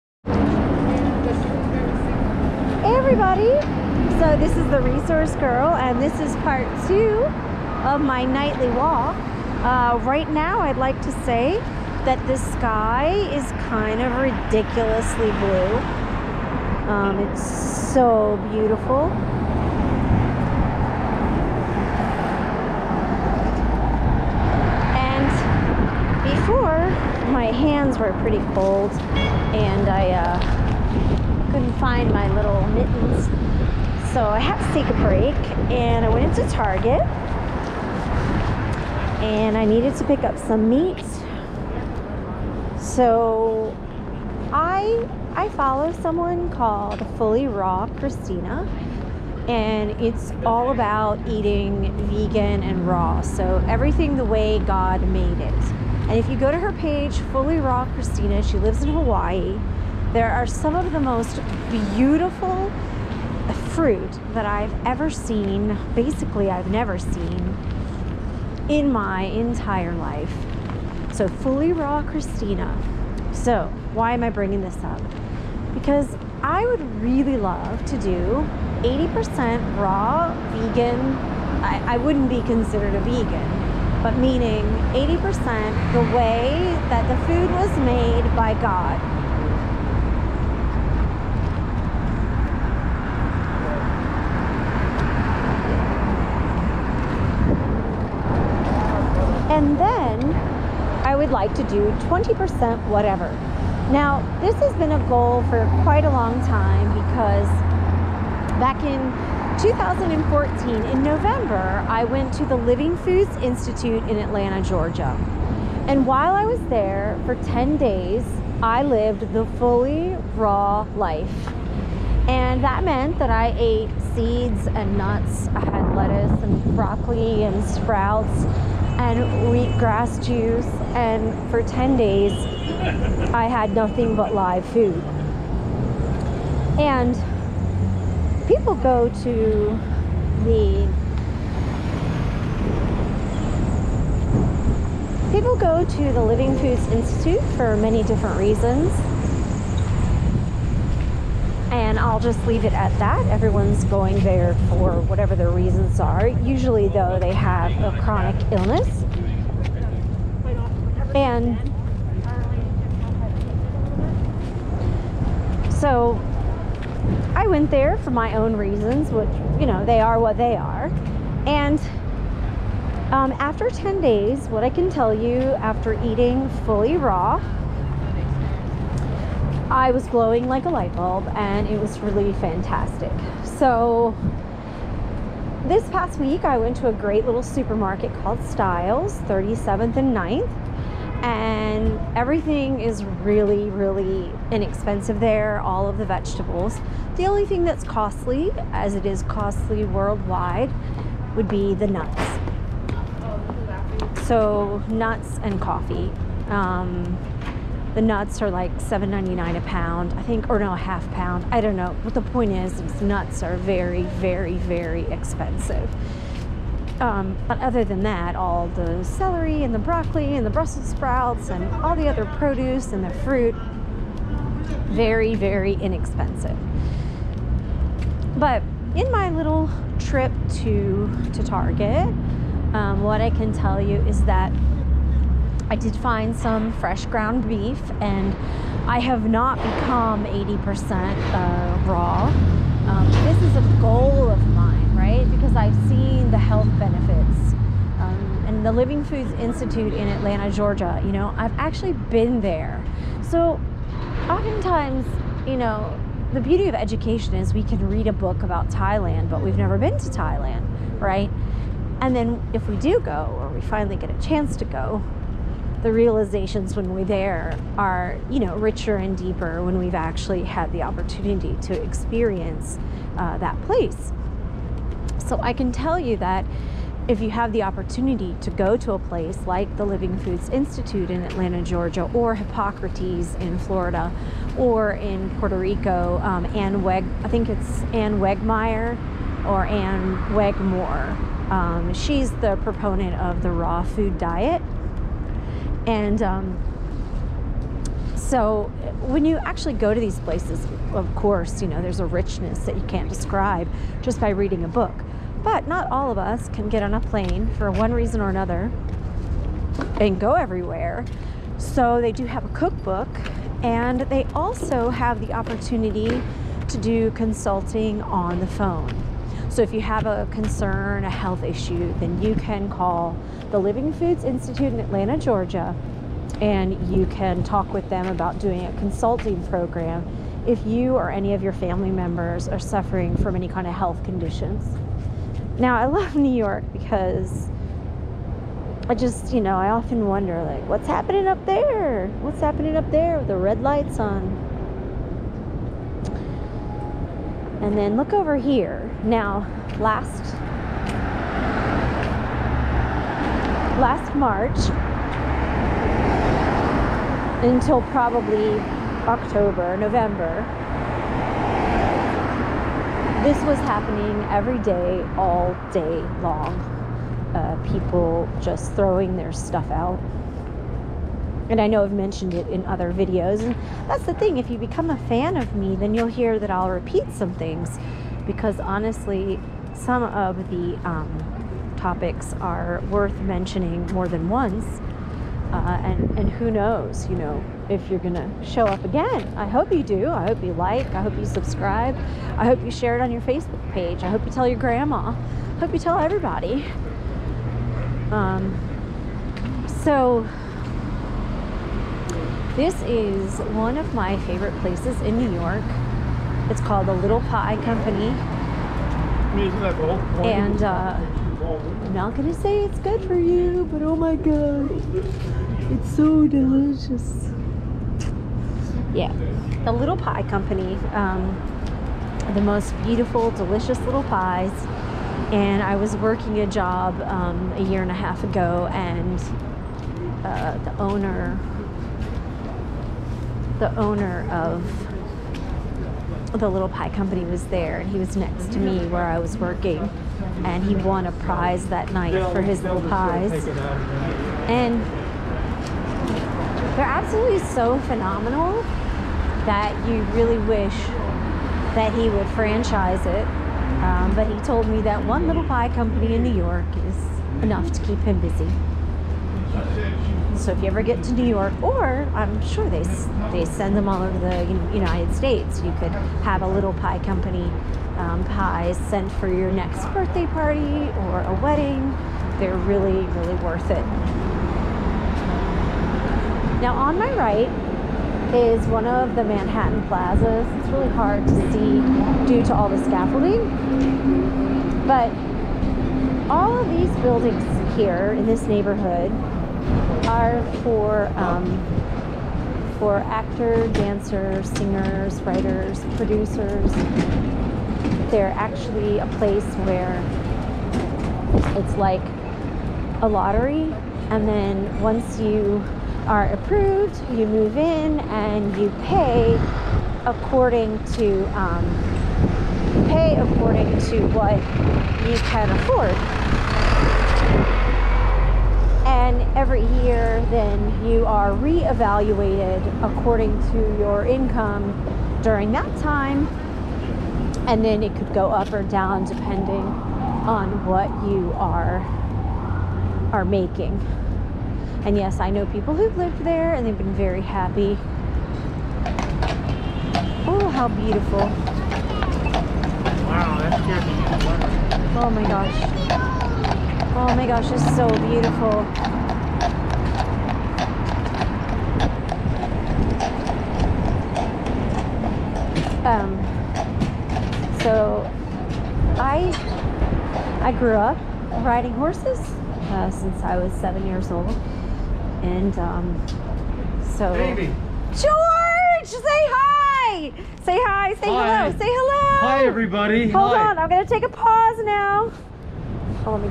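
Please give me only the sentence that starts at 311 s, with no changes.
So they do have a cookbook, and they also have the opportunity to do consulting on the phone.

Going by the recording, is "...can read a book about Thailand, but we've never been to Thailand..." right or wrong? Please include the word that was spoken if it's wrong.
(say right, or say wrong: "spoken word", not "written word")
right.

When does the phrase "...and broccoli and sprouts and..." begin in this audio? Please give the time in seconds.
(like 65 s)
126 s.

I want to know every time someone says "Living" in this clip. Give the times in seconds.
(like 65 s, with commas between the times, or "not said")
112 s, 146 s, 248 s, 279 s, 323 s.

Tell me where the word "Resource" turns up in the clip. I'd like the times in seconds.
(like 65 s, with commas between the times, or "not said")
4 s.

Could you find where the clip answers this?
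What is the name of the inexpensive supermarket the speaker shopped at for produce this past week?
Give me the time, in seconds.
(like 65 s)
188 s.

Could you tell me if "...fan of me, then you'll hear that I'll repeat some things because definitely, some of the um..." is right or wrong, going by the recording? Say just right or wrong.
wrong.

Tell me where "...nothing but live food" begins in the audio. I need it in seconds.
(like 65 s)
133 s.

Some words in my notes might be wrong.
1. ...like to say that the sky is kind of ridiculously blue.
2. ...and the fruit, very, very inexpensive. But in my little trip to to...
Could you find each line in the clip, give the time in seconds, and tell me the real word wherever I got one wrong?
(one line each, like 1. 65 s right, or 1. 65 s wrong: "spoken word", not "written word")
1. 10 s right
2. 222 s right.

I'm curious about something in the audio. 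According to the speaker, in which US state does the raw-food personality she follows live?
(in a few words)
Hawaii.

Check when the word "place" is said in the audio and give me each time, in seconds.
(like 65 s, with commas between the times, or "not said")
273 s, 278 s, 300 s, 404 s, 499 s.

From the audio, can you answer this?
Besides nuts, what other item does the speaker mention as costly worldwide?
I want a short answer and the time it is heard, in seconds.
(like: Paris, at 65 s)
coffee, at 205 s.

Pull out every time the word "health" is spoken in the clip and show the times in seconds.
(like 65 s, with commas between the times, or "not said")
246 s, 321 s, 333 s.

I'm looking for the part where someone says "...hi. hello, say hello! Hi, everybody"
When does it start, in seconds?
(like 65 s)
571 s.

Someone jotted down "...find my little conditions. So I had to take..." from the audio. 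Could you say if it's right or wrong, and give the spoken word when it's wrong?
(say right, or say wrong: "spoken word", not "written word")
wrong: "mittens", not "conditions".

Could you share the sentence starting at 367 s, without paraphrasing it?
Uh, people just throwing their stuff out.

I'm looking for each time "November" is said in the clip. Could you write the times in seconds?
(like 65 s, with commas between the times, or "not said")
111 s, 359 s.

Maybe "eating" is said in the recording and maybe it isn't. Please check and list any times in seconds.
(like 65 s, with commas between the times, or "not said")
51 s, 176 s.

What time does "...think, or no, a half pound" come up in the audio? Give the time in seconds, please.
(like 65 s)
210 s.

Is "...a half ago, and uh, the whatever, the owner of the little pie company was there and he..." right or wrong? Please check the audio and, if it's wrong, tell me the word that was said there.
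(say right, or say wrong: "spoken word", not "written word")
wrong: "owner", not "whatever".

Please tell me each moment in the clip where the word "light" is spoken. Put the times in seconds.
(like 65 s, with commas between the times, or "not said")
180 s, 343 s.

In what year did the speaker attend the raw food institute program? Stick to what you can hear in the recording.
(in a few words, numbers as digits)
2014.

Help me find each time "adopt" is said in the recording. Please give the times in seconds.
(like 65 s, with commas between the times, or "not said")
not said.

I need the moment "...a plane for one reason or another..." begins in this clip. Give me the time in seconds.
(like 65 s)
306 s.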